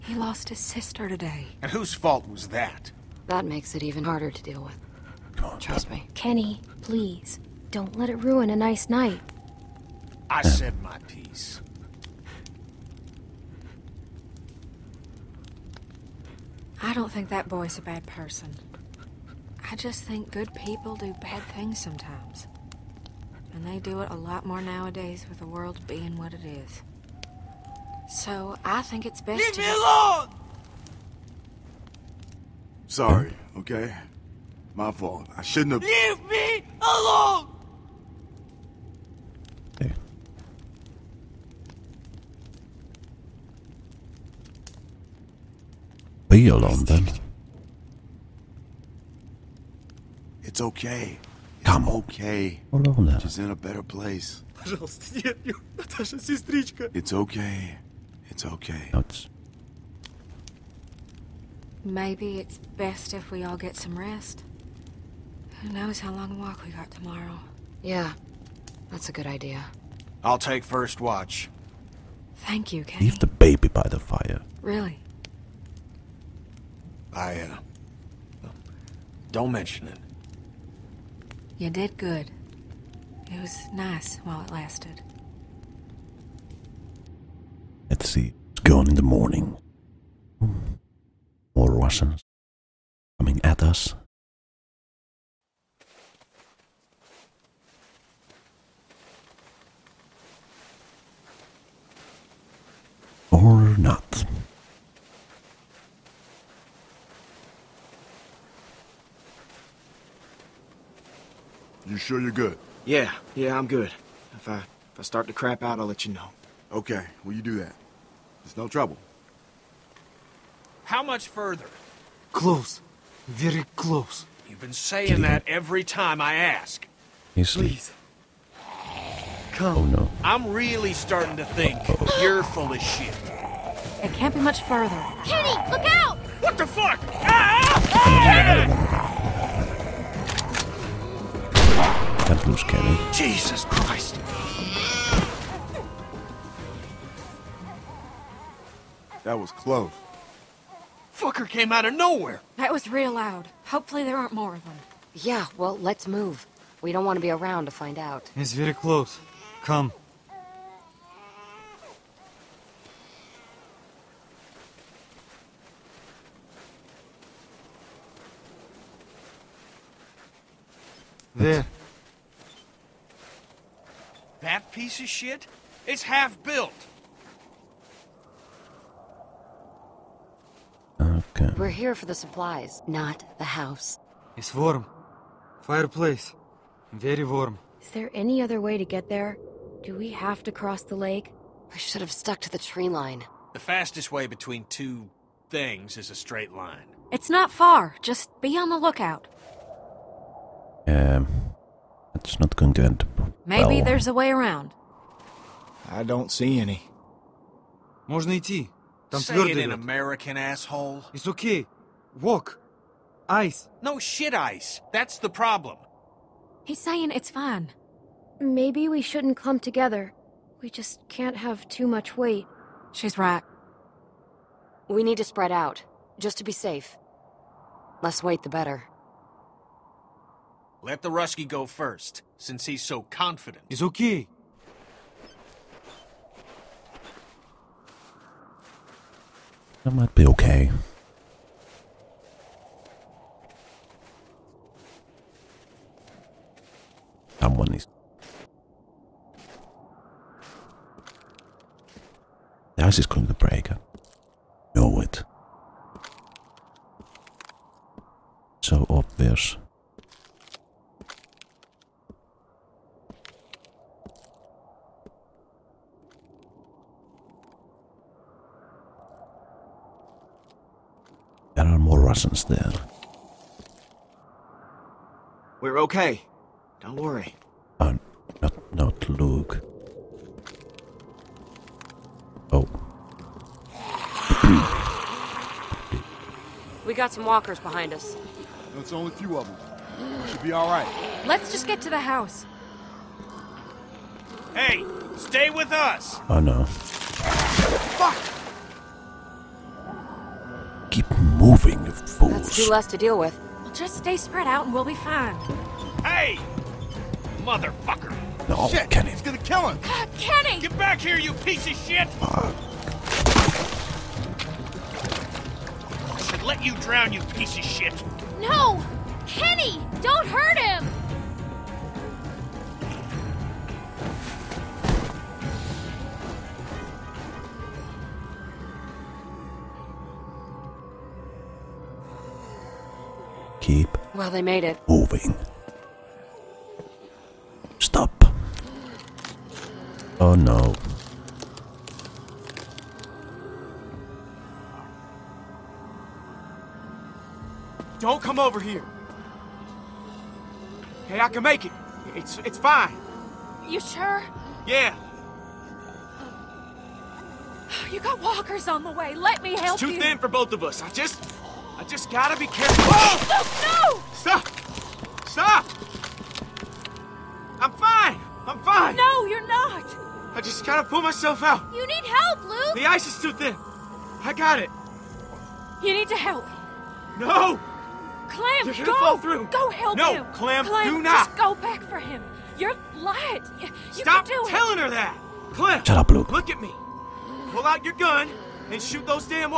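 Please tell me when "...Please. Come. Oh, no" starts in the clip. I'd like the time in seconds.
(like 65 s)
127 s.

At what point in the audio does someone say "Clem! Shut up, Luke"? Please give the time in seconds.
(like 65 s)
385 s.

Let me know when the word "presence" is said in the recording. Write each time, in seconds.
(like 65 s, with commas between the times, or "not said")
272 s.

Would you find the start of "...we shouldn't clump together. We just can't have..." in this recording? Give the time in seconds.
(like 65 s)
218 s.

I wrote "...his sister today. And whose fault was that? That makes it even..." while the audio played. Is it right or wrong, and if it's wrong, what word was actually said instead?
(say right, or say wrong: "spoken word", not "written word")
right.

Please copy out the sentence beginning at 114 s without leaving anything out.
If I, if I start to crap out, I'll let you know.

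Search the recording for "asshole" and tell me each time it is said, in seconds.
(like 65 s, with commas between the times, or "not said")
210 s.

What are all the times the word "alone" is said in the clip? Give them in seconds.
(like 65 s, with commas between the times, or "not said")
29 s, 36 s, 46 s.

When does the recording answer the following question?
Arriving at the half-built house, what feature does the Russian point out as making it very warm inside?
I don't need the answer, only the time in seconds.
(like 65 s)
185 s.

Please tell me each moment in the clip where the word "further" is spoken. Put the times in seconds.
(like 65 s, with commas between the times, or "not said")
121 s, 134 s.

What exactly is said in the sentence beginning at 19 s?
I just think good people do bad things sometimes.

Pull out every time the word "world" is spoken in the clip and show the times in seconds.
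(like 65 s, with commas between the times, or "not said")
25 s.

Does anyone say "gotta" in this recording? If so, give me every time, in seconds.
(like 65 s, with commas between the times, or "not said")
362 s, 370 s.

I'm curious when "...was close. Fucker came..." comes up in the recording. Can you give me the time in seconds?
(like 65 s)
149 s.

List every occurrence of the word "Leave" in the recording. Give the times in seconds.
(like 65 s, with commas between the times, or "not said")
29 s, 35 s, 73 s.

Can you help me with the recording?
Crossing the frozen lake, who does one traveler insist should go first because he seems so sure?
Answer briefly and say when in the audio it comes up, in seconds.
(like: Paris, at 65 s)
The Russki, at 230 s.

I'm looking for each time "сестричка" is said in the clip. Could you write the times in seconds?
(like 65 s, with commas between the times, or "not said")
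56 s.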